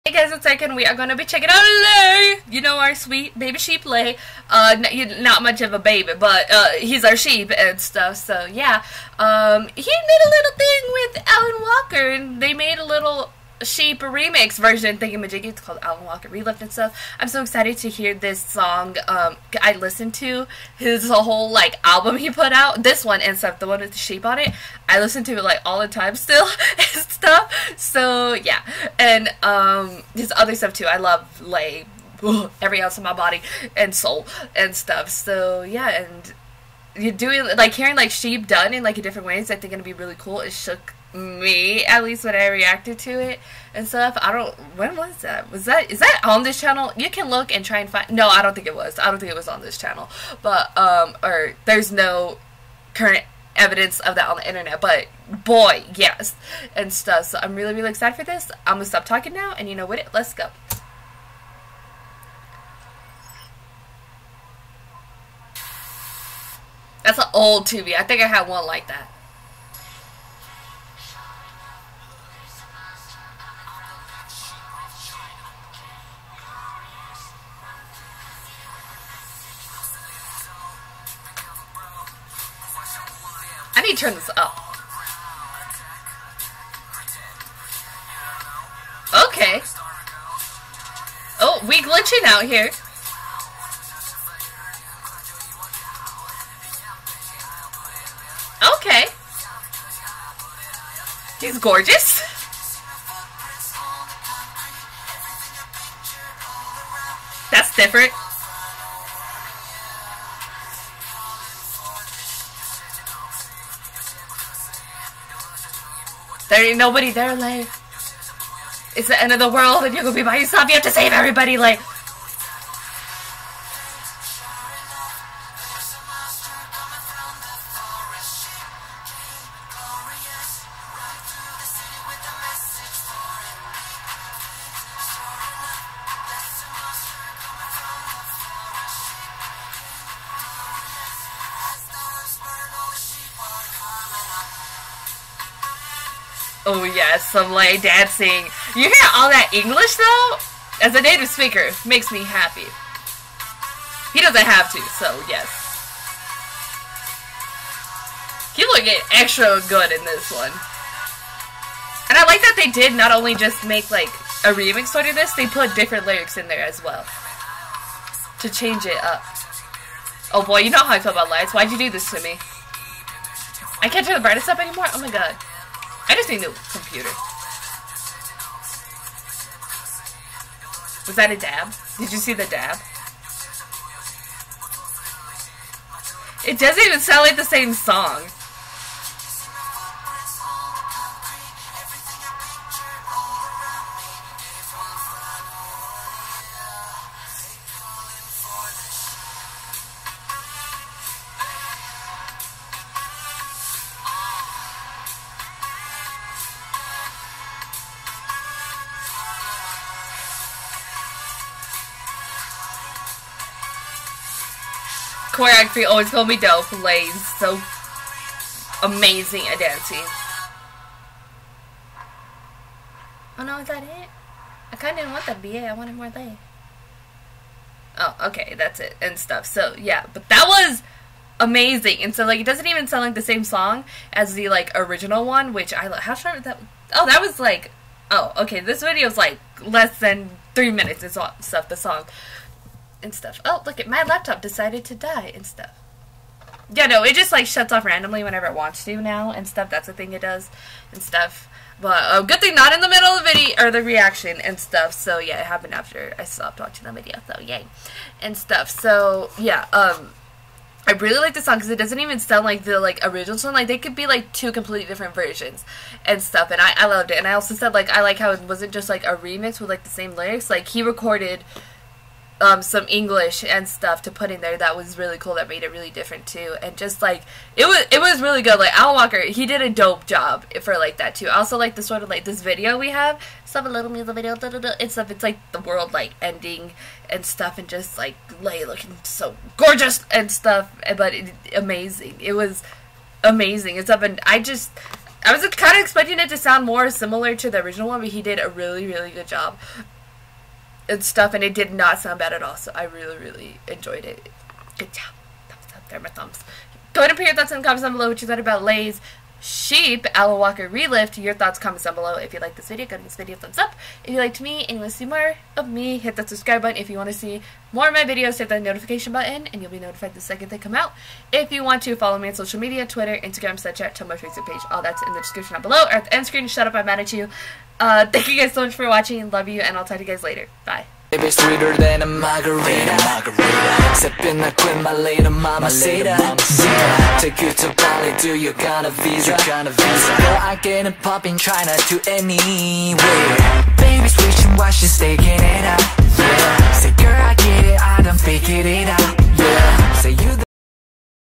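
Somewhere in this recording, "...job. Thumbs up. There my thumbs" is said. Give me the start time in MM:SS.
05:04.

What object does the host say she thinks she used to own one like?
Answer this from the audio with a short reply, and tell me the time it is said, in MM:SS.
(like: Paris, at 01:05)
An old TV, at 01:07.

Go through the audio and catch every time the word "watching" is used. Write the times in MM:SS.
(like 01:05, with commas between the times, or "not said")
04:16, 05:28.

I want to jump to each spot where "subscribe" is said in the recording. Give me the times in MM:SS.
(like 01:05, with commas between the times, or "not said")
05:16.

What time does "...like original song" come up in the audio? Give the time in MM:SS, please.
04:22.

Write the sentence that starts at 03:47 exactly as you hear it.
Oh, okay, that's it, and stuff.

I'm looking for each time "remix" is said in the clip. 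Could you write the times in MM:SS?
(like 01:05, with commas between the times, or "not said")
00:14, 02:44, 04:29.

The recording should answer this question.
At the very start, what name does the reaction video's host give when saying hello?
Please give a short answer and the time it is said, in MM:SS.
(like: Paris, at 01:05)
Erika, at 00:00.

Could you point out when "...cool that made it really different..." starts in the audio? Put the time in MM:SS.
04:35.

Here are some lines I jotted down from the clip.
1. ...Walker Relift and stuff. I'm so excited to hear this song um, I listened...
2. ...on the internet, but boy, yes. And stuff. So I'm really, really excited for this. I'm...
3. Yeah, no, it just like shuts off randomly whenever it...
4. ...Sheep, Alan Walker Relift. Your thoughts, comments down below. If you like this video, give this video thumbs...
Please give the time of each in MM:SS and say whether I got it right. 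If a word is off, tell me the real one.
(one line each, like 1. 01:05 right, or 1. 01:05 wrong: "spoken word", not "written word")
1. 00:16 right
2. 00:54 right
3. 04:06 right
4. 05:09 right.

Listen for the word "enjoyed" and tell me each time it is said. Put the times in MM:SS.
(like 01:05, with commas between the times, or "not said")
05:03.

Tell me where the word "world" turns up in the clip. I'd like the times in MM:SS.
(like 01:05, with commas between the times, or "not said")
01:59, 04:45.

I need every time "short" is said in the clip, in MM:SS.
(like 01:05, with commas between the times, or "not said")
03:56.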